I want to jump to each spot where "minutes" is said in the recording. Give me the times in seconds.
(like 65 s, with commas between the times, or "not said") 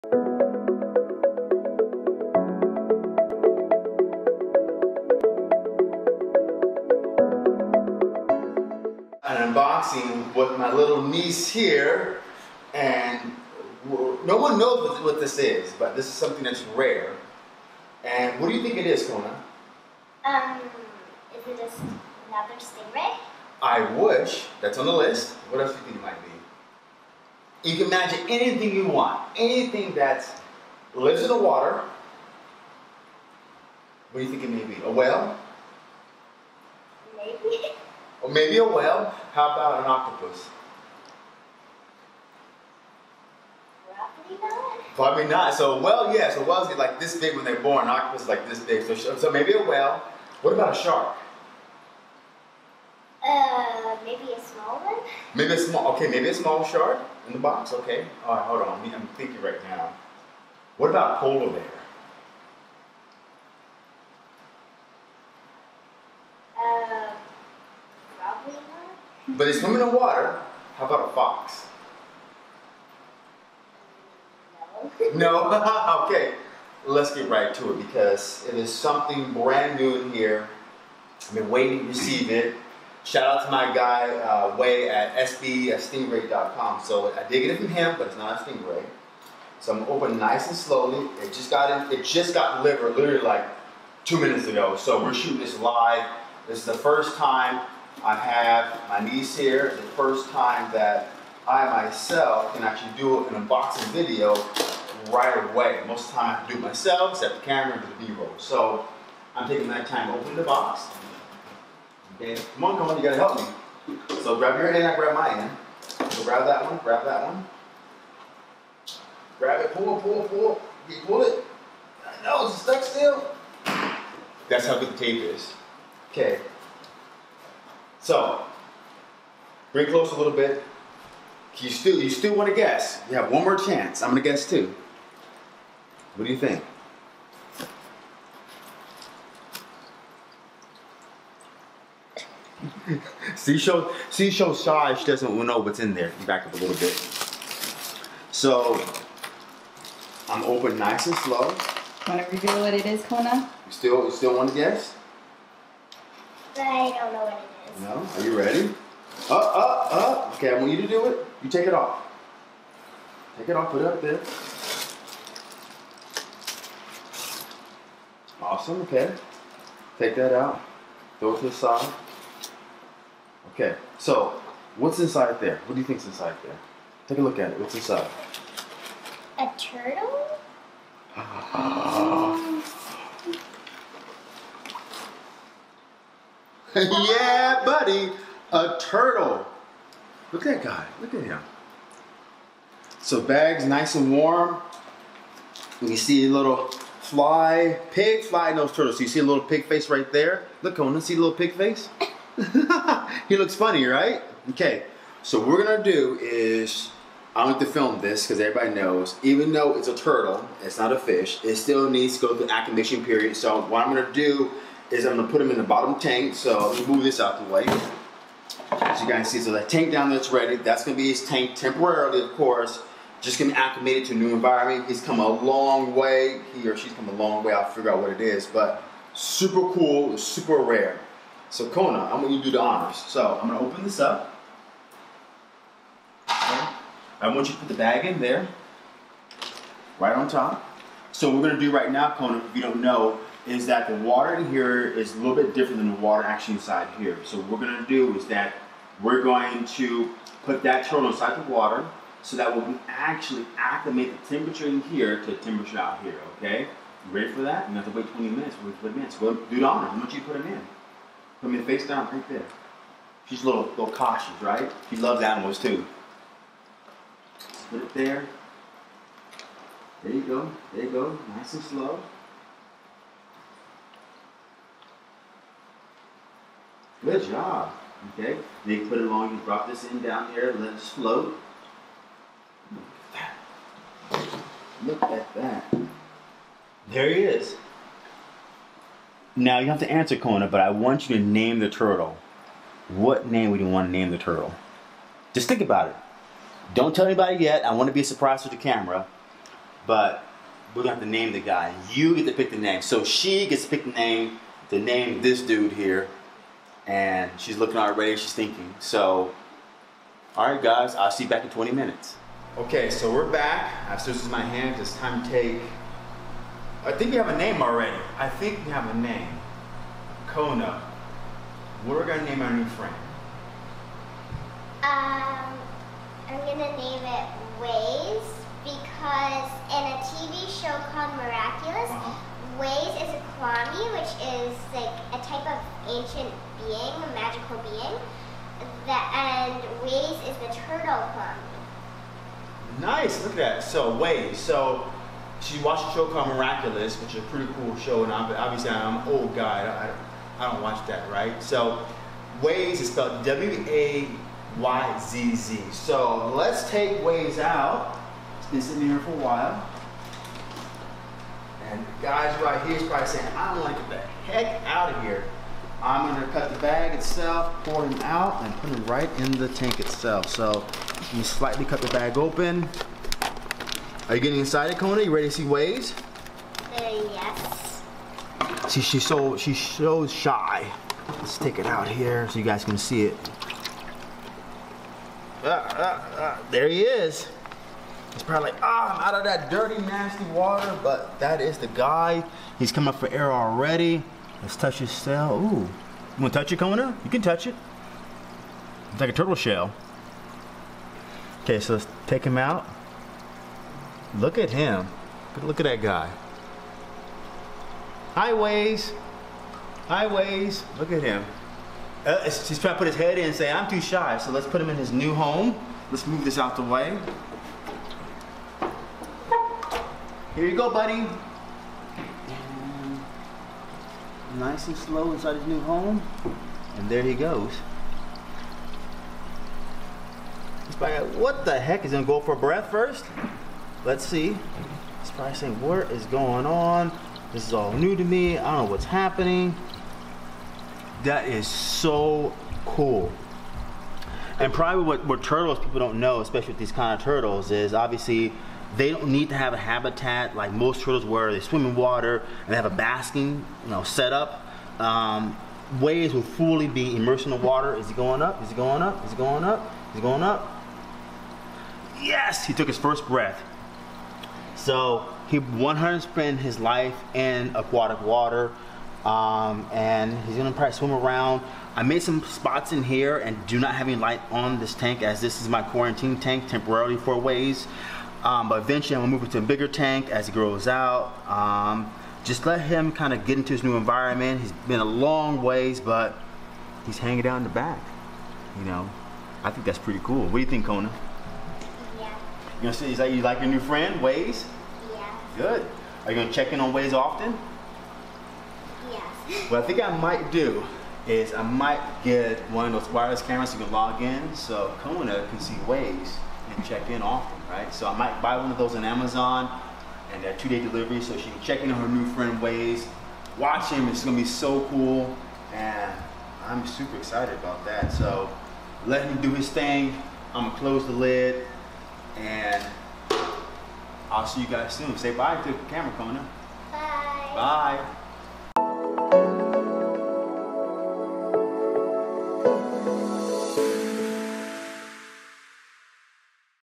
94 s, 258 s, 311 s.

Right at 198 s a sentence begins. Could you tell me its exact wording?
So you see a little pig face right there.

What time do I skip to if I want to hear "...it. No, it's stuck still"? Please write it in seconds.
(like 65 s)
121 s.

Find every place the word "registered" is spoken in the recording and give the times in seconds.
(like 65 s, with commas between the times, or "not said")
not said.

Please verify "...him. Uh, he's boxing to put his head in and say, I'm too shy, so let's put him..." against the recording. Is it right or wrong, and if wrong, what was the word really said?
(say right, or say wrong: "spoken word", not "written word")
wrong: "trying", not "boxing".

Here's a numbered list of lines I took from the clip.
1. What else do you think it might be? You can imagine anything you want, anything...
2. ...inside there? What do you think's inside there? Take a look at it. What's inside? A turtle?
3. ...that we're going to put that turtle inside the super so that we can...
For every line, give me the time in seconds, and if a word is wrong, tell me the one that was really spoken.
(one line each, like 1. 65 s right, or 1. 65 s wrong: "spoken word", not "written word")
1. 25 s right
2. 174 s right
3. 248 s wrong: "water", not "super".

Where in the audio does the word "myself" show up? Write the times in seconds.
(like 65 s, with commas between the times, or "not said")
101 s, 106 s.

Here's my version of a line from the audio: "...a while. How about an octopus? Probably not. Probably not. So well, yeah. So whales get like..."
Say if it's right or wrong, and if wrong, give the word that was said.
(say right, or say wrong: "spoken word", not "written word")
wrong: "whale", not "while".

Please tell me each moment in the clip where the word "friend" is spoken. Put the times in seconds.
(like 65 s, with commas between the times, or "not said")
322 s, 493 s, 512 s.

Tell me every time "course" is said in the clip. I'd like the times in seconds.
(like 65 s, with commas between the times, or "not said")
222 s.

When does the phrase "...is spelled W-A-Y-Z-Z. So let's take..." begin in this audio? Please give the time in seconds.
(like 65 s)
352 s.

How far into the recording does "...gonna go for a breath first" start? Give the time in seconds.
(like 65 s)
431 s.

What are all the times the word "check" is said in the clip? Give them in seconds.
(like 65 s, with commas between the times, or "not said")
496 s, 506 s, 511 s.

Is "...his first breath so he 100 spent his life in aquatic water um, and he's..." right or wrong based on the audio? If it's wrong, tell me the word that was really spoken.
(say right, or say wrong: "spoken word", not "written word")
right.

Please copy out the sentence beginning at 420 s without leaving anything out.
And nice and slow inside his new home.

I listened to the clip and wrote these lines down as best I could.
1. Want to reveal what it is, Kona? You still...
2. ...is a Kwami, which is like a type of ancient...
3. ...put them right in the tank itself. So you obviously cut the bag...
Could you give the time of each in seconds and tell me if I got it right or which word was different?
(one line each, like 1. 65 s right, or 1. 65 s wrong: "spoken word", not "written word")
1. 152 s right
2. 332 s right
3. 368 s wrong: "slightly", not "obviously".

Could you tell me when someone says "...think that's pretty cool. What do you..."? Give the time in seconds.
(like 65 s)
489 s.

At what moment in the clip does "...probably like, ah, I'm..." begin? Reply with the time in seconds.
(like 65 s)
388 s.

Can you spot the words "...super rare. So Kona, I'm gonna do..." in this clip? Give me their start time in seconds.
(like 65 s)
230 s.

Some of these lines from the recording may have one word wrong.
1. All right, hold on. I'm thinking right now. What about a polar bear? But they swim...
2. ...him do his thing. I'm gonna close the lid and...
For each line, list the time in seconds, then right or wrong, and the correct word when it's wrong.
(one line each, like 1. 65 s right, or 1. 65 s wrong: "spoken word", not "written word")
1. 58 s right
2. 519 s right.